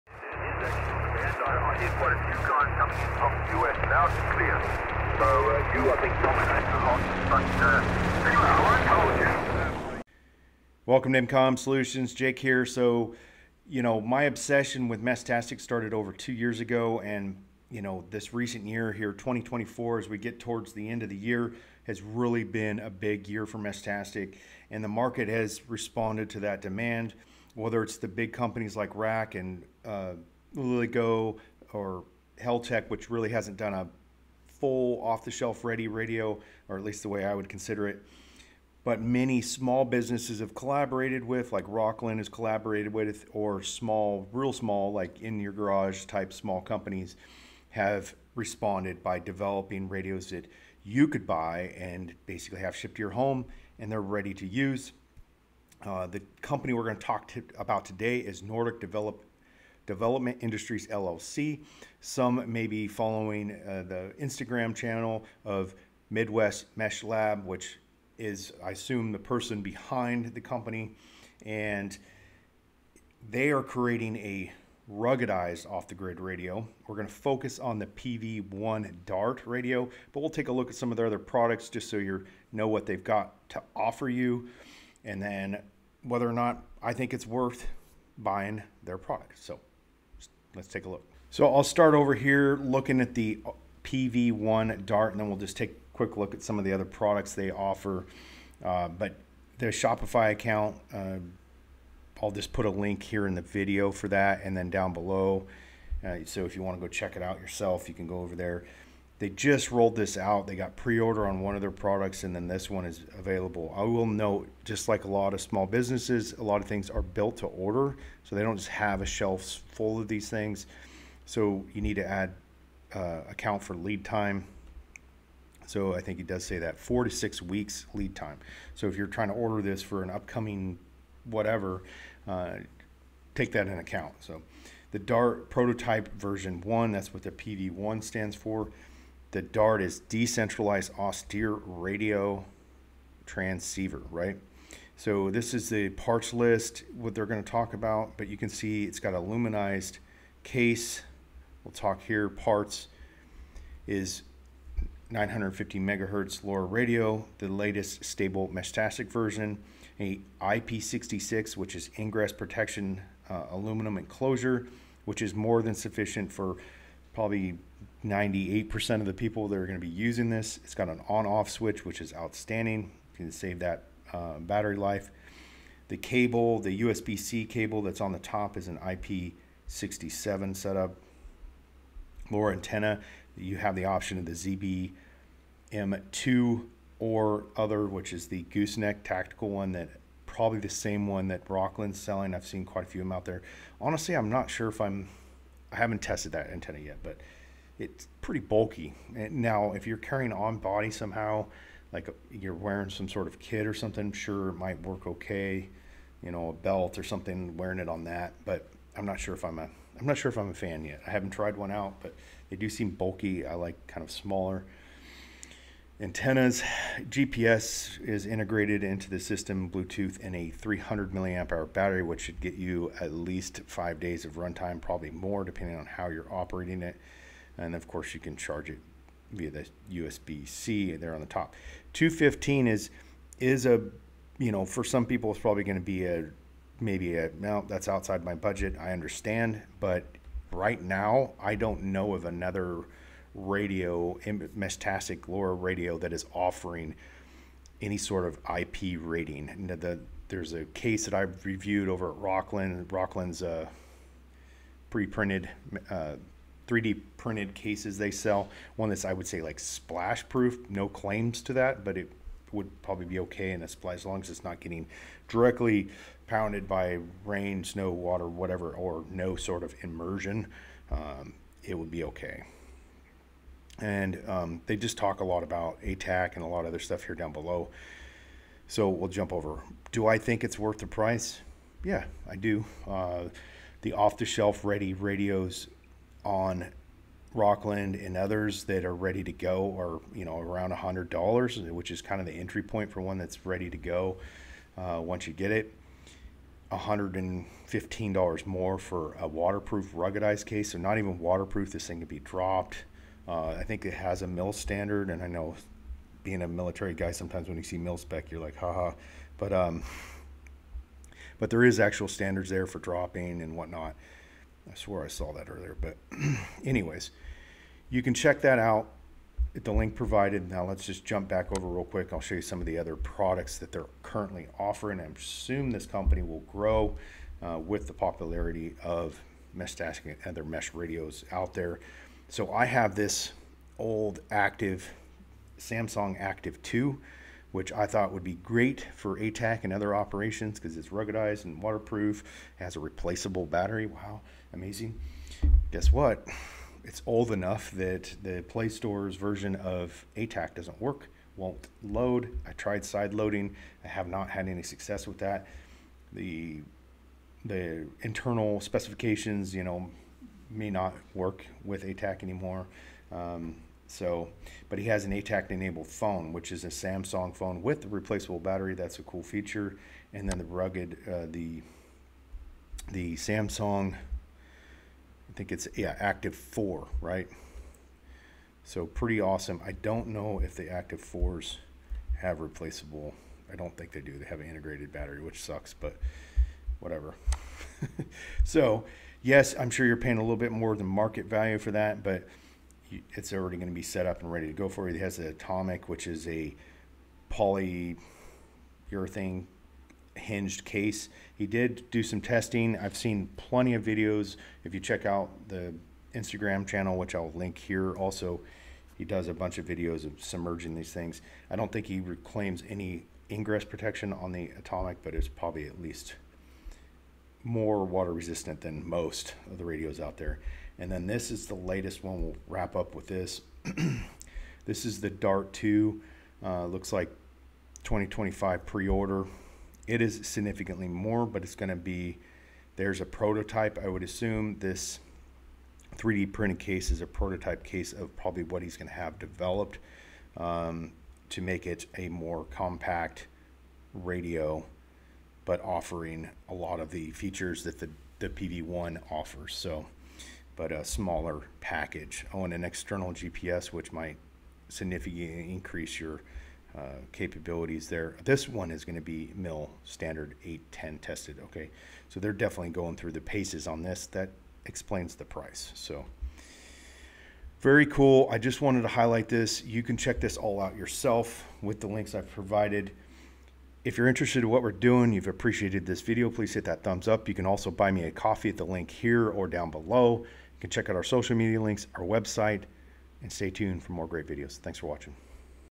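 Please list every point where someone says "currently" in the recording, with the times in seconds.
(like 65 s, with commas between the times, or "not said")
324 s.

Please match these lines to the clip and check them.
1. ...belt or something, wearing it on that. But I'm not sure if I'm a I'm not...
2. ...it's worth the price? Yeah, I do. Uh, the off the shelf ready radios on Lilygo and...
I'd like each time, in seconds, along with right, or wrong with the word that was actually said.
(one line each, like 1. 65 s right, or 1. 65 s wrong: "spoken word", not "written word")
1. 206 s right
2. 280 s wrong: "Rokland", not "Lilygo".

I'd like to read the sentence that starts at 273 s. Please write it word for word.
And um, they just talk a lot about ATAK and a lot of other stuff here down below.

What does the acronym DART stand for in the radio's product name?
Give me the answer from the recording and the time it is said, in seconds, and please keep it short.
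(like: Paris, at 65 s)
Decentralized austere radio transceiver, at 139 s.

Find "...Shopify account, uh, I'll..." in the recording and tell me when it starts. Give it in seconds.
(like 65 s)
99 s.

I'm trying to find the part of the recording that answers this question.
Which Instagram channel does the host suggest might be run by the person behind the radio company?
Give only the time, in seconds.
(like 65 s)
66 s.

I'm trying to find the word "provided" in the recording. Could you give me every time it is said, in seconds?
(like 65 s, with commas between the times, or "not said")
319 s, 472 s.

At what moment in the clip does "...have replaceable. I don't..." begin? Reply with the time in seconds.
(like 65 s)
382 s.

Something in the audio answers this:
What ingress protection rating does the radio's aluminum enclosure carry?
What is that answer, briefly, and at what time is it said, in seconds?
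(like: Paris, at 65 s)
IP66, at 160 s.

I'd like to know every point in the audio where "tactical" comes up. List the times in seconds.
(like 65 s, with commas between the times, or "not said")
189 s.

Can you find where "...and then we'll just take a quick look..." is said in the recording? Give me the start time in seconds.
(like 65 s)
95 s.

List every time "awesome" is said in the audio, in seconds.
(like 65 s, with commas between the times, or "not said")
379 s.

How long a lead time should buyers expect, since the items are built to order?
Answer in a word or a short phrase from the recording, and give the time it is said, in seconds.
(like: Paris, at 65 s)
4 to 6 weeks, at 126 s.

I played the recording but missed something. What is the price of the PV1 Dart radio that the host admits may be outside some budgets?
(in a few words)
$215.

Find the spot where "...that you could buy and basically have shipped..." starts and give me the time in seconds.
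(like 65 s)
50 s.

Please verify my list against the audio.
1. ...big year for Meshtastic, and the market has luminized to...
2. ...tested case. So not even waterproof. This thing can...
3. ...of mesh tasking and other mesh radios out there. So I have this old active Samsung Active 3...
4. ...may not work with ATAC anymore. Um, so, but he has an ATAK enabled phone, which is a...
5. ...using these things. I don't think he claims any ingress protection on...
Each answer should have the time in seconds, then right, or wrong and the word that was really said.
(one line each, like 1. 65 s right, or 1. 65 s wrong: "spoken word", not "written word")
1. 22 s wrong: "responded", not "luminized"
2. 299 s wrong: "ruggedized", not "tested"
3. 328 s wrong: "2", not "3"
4. 360 s right
5. 410 s wrong: "submerging", not "using".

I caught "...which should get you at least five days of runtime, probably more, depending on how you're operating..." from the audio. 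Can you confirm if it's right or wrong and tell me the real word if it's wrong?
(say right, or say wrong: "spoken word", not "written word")
right.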